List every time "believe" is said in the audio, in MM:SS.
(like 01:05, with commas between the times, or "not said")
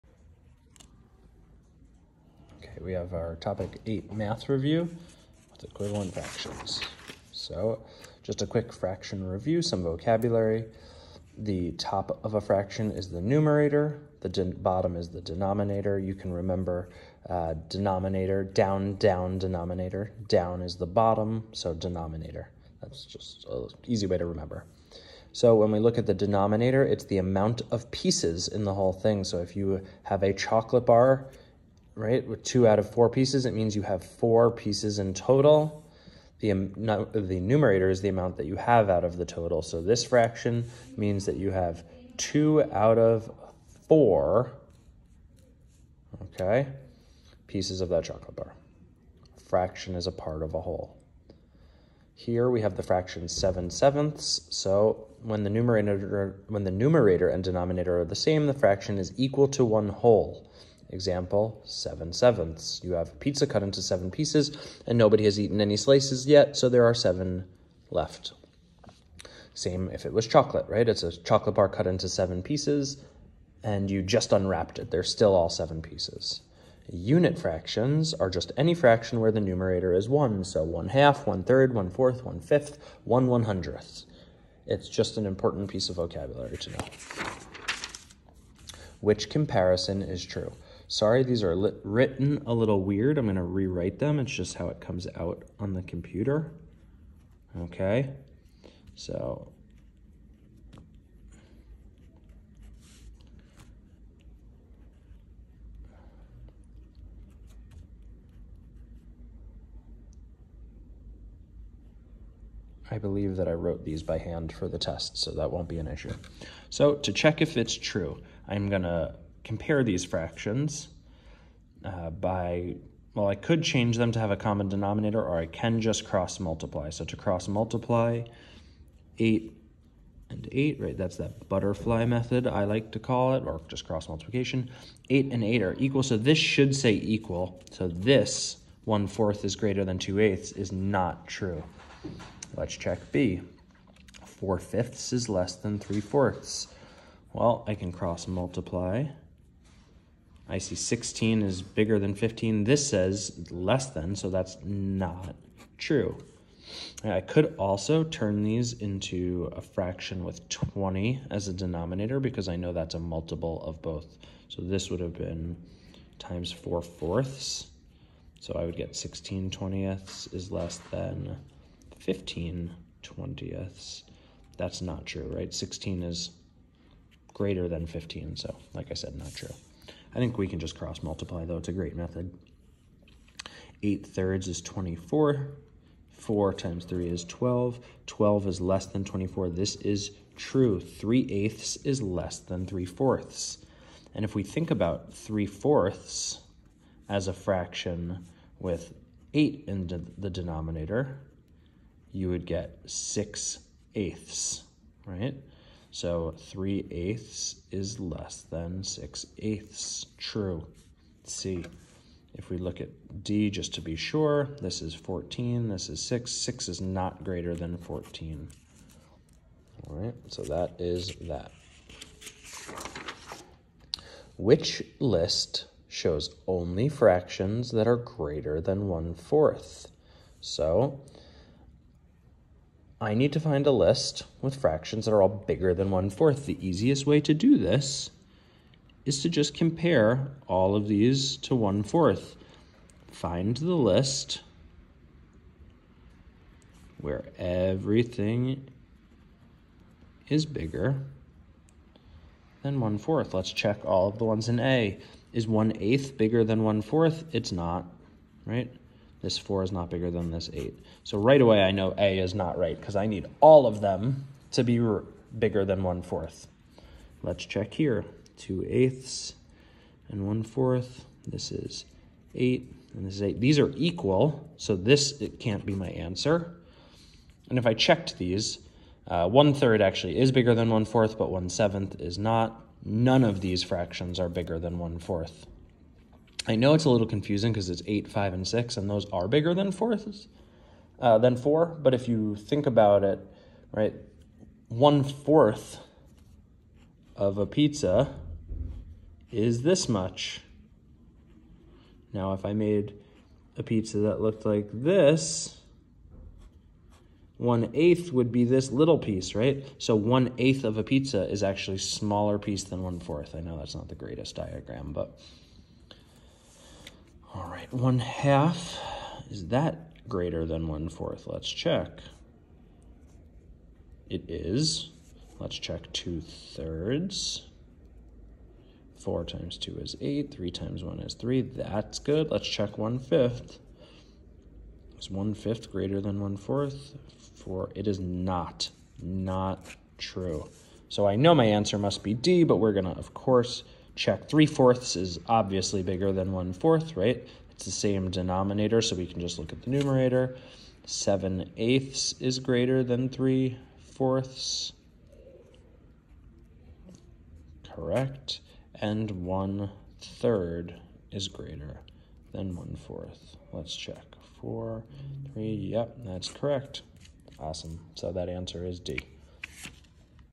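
01:52.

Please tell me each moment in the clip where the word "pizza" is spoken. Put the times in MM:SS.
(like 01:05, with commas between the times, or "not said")
01:03, 04:57, 05:03, 05:10.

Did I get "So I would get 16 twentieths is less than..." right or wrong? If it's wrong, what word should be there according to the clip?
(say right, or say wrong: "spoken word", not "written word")
right.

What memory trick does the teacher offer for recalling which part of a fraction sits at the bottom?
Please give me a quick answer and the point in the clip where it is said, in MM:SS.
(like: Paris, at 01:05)
down, down, denominator, at 00:18.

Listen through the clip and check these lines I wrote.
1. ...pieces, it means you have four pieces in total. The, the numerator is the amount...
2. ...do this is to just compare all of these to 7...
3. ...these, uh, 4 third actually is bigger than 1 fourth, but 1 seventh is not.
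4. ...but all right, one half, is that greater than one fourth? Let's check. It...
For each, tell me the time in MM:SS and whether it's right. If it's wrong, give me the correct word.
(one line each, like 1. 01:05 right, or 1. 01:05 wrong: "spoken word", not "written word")
1. 00:33 right
2. 03:57 wrong: "1", not "7"
3. 04:38 wrong: "1", not "4"
4. 05:14 right.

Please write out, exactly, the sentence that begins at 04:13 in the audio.
Let's check all of the ones in A.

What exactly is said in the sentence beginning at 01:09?
Same if it was chocolate, right?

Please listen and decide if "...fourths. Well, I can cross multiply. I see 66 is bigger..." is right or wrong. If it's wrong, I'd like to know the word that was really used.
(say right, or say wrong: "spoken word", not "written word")
wrong: "16", not "66".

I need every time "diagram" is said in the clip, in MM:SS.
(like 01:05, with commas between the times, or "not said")
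05:14.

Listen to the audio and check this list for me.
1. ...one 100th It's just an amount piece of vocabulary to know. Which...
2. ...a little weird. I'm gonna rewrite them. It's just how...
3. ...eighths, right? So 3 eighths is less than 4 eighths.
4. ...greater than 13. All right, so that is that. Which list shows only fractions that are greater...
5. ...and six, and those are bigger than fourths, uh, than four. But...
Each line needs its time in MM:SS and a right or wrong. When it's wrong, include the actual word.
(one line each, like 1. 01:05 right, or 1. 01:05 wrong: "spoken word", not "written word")
1. 01:23 wrong: "important", not "amount"
2. 01:32 right
3. 03:23 wrong: "6", not "4"
4. 03:37 wrong: "14", not "13"
5. 04:48 right.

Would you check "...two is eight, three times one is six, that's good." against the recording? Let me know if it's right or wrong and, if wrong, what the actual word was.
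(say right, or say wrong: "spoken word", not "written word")
wrong: "three", not "six".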